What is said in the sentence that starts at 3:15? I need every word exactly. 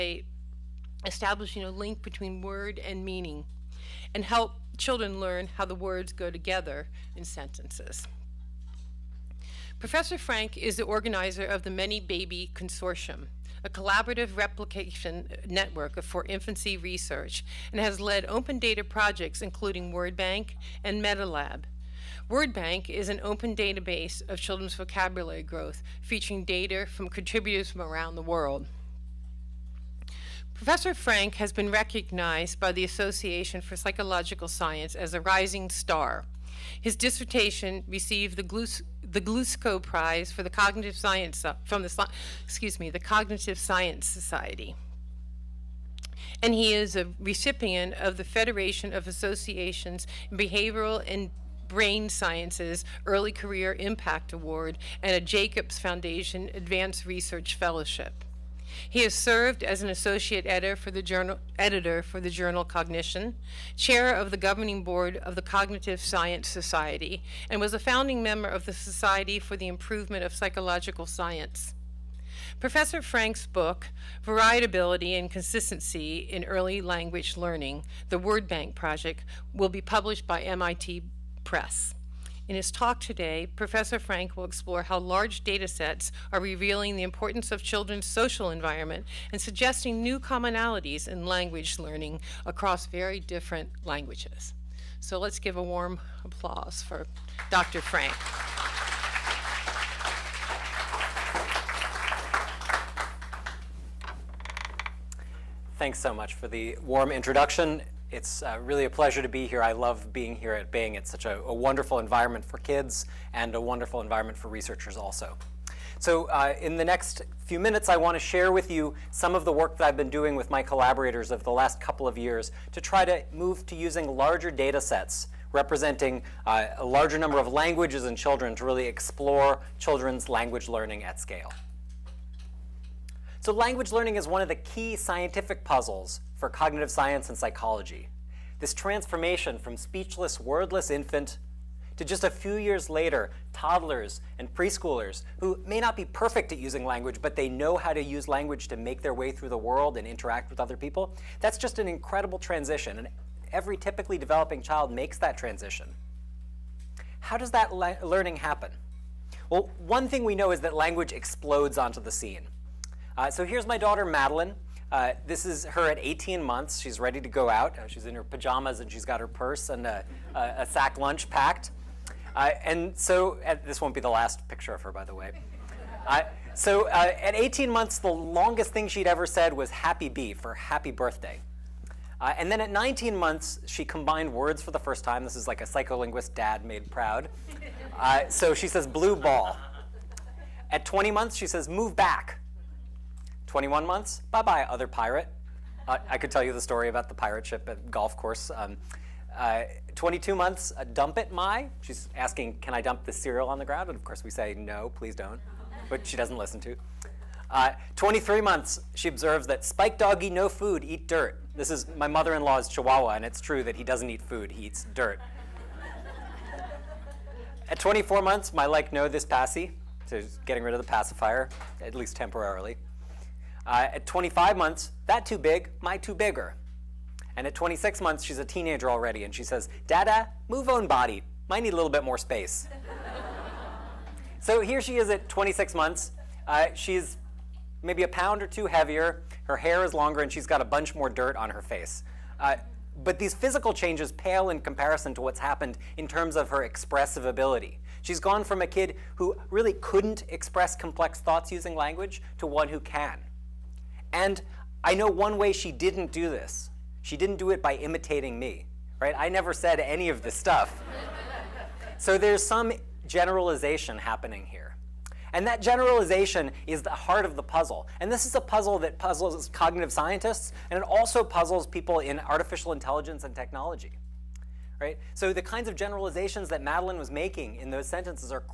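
Uh, I could tell you the story about the pirate ship at golf course.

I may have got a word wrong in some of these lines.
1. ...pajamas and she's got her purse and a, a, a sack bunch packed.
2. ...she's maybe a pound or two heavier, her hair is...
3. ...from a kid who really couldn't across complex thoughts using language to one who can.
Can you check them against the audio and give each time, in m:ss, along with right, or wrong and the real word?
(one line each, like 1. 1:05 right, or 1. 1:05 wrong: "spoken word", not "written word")
1. 2:48 wrong: "lunch", not "bunch"
2. 3:56 right
3. 4:08 wrong: "express", not "across".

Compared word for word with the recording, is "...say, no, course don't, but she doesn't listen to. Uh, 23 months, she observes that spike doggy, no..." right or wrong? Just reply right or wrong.
wrong.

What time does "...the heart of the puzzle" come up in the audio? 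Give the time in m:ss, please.
4:26.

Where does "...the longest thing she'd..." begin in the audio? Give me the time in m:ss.
2:57.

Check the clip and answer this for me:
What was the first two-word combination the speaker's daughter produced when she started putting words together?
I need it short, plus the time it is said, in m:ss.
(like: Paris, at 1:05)
blue ball, at 3:08.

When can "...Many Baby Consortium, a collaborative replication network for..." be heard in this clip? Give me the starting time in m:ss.
0:11.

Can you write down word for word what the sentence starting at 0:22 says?
WordBank is an open database of children's vocabulary growth, featuring data from contributors from around the world.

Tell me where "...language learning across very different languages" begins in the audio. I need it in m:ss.
1:31.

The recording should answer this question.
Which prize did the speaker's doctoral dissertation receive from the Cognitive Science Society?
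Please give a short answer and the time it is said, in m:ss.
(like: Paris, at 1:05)
Glushko Prize, at 0:39.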